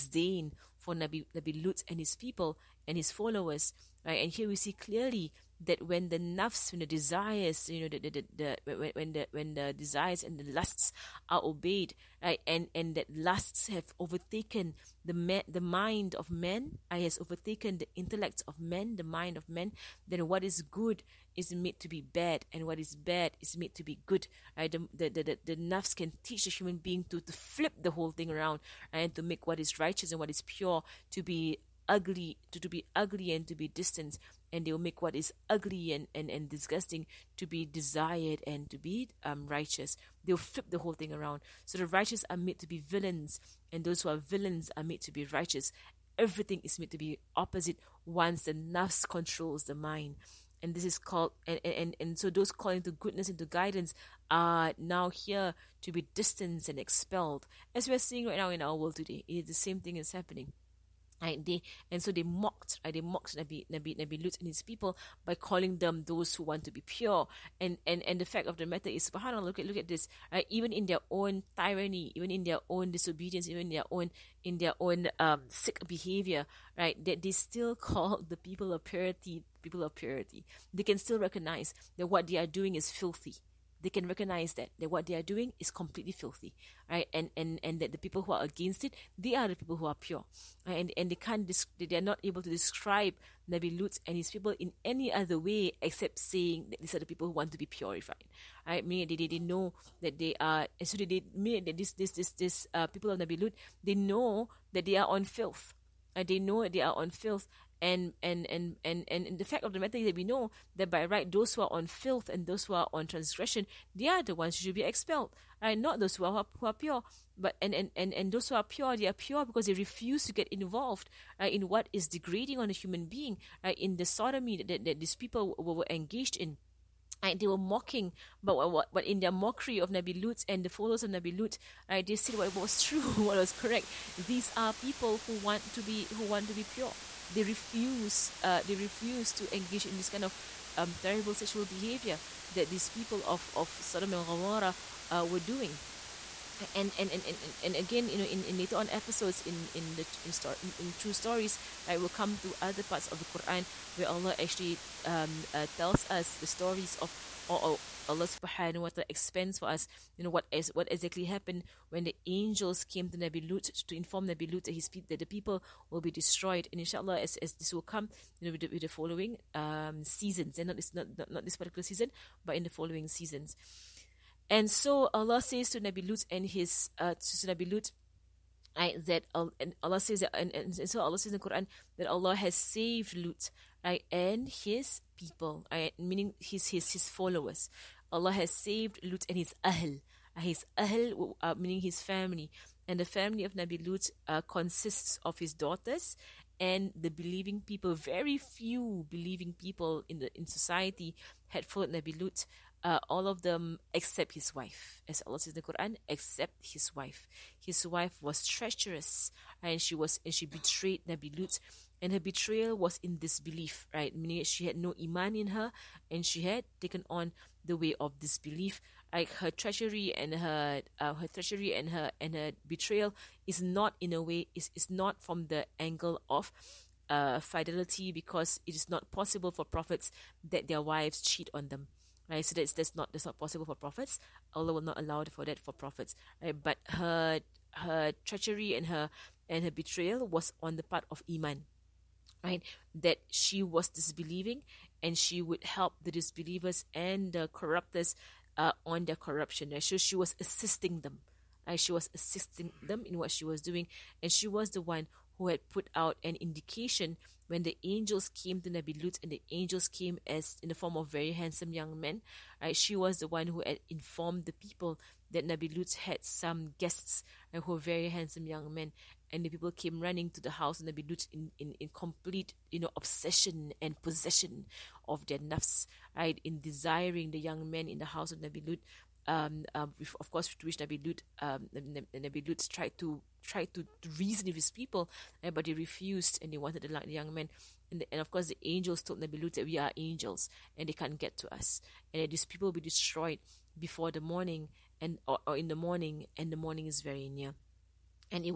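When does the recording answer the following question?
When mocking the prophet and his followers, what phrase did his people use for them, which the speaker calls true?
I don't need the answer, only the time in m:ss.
1:06.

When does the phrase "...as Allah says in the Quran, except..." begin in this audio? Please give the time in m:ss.
3:25.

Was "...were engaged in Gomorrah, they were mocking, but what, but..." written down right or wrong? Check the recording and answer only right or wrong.
wrong.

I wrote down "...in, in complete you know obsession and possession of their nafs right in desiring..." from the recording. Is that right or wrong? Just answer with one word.
right.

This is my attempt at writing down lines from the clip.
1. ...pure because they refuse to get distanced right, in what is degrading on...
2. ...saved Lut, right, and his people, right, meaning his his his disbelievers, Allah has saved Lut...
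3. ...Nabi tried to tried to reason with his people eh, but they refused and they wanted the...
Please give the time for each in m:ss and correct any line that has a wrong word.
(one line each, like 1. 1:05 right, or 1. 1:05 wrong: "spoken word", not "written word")
1. 1:59 wrong: "involved", not "distanced"
2. 3:02 wrong: "followers", not "disbelievers"
3. 4:42 right.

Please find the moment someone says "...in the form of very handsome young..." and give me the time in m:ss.
4:20.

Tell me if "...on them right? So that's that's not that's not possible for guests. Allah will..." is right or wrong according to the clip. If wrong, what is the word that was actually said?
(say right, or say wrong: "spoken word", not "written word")
wrong: "prophets", not "guests".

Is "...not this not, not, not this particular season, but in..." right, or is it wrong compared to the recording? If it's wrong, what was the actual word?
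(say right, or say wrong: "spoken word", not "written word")
right.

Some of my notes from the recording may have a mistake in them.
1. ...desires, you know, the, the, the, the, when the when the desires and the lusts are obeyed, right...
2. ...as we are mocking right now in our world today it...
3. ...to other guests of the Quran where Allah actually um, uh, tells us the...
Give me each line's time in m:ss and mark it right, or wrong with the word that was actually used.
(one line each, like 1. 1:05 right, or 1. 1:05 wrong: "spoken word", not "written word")
1. 0:06 right
2. 0:57 wrong: "seeing", not "mocking"
3. 2:32 wrong: "parts", not "guests".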